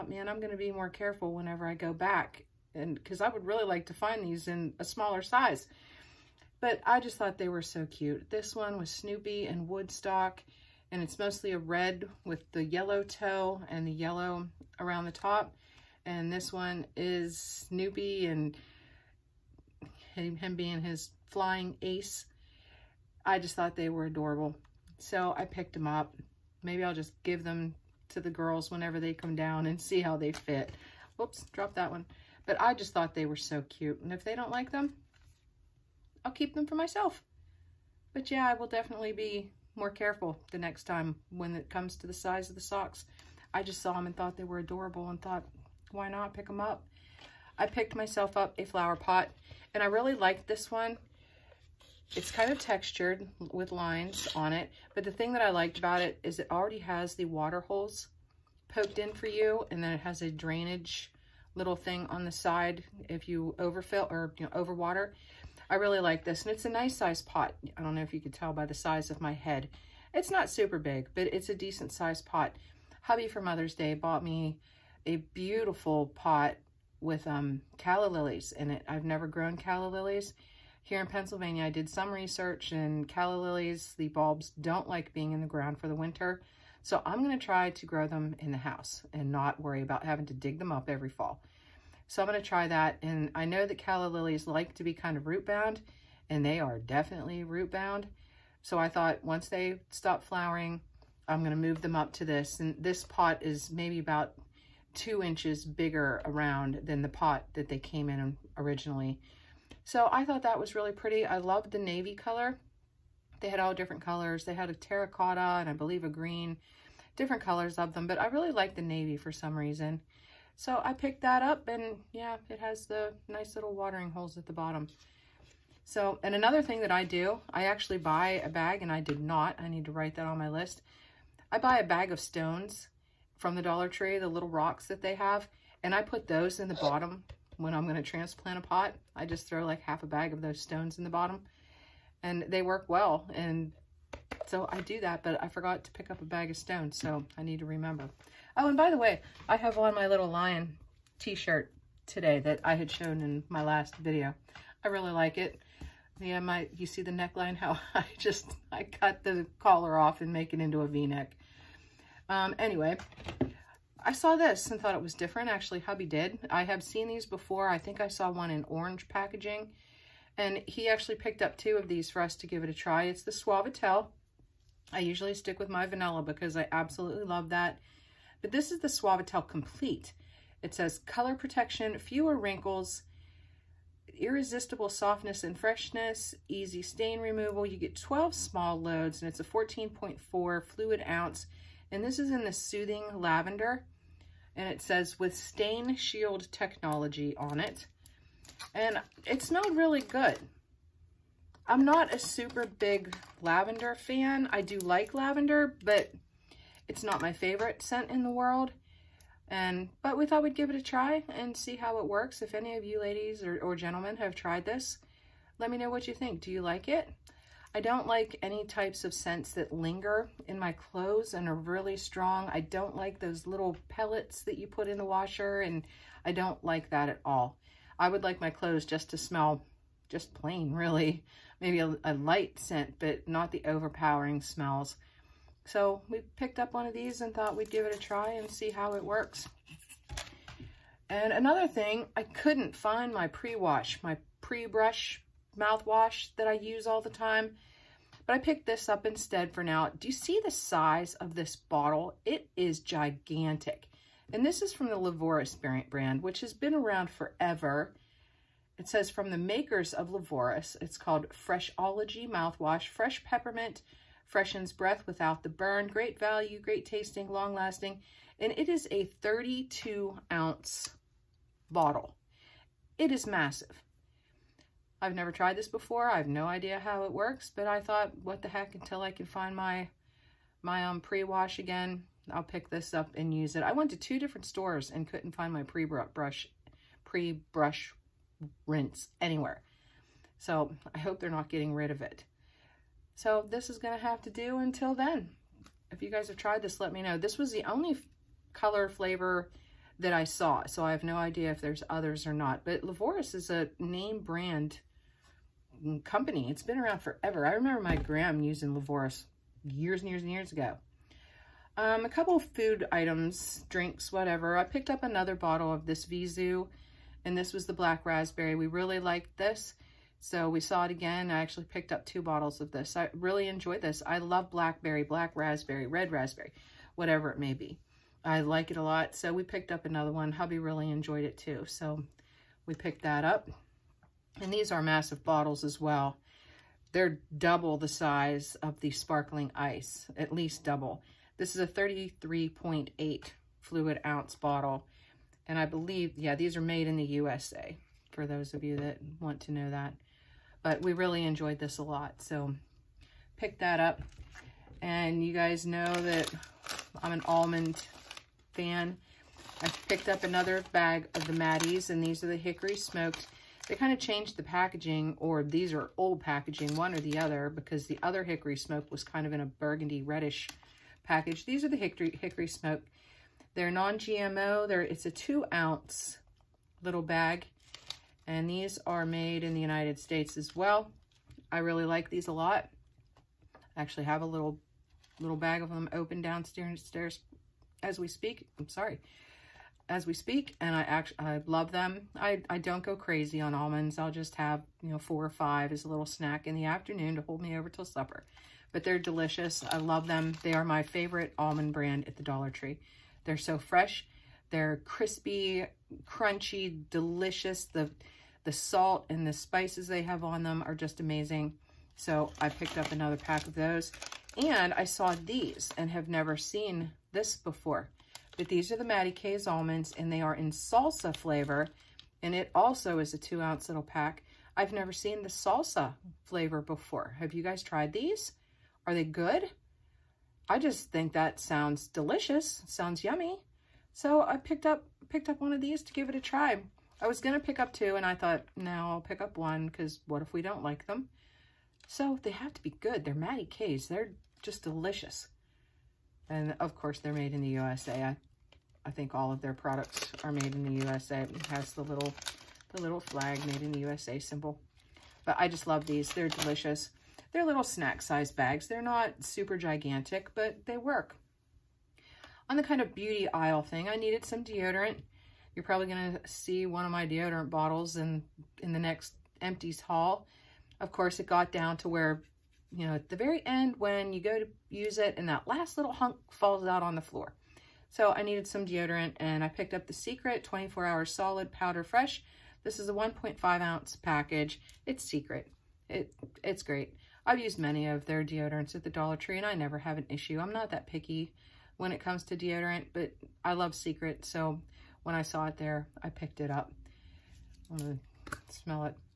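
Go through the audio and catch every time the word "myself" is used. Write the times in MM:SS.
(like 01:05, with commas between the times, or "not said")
00:36, 00:47.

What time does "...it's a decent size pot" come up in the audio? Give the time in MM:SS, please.
01:11.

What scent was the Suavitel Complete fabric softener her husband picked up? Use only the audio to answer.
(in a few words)
Soothing Lavender.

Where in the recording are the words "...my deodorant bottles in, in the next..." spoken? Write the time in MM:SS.
07:46.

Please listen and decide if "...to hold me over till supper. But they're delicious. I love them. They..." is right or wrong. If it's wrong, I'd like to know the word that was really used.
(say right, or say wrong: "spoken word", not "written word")
right.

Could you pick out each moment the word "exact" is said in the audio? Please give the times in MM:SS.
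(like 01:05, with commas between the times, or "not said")
not said.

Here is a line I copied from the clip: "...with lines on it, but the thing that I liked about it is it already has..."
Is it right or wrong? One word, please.
right.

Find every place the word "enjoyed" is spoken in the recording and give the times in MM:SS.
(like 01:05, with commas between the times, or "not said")
05:23, 05:30, 05:51.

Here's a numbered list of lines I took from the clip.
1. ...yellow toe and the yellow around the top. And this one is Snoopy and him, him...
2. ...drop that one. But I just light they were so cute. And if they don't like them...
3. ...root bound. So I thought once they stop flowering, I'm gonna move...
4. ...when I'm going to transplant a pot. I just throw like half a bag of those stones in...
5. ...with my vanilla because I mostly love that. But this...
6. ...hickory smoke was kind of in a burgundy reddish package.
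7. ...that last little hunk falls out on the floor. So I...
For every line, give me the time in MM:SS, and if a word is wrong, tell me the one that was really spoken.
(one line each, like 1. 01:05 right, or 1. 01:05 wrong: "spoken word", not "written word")
1. 00:12 right
2. 00:31 wrong: "thought", not "light"
3. 01:37 right
4. 02:17 right
5. 02:55 wrong: "absolutely", not "mostly"
6. 06:08 right
7. 07:55 right.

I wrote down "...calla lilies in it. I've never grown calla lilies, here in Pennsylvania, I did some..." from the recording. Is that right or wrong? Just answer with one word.
right.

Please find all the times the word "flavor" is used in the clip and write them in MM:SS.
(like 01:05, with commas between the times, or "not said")
04:58, 07:01, 07:06.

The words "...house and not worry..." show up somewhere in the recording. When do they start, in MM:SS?
01:28.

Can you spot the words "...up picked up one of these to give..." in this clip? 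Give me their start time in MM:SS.
07:14.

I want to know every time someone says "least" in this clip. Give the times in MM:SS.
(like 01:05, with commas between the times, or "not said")
05:40.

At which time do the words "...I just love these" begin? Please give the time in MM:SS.
07:35.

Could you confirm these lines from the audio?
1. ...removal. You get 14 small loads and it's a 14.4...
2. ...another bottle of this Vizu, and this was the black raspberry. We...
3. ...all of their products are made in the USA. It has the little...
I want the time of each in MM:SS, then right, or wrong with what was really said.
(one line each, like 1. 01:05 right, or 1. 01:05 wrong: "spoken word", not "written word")
1. 03:07 wrong: "12", not "14"
2. 05:15 right
3. 07:29 right.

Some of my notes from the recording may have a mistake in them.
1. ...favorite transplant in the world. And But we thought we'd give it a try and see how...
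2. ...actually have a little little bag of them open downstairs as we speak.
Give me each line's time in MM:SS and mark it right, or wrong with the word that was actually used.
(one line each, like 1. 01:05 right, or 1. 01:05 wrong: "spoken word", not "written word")
1. 03:27 wrong: "scent", not "transplant"
2. 06:23 right.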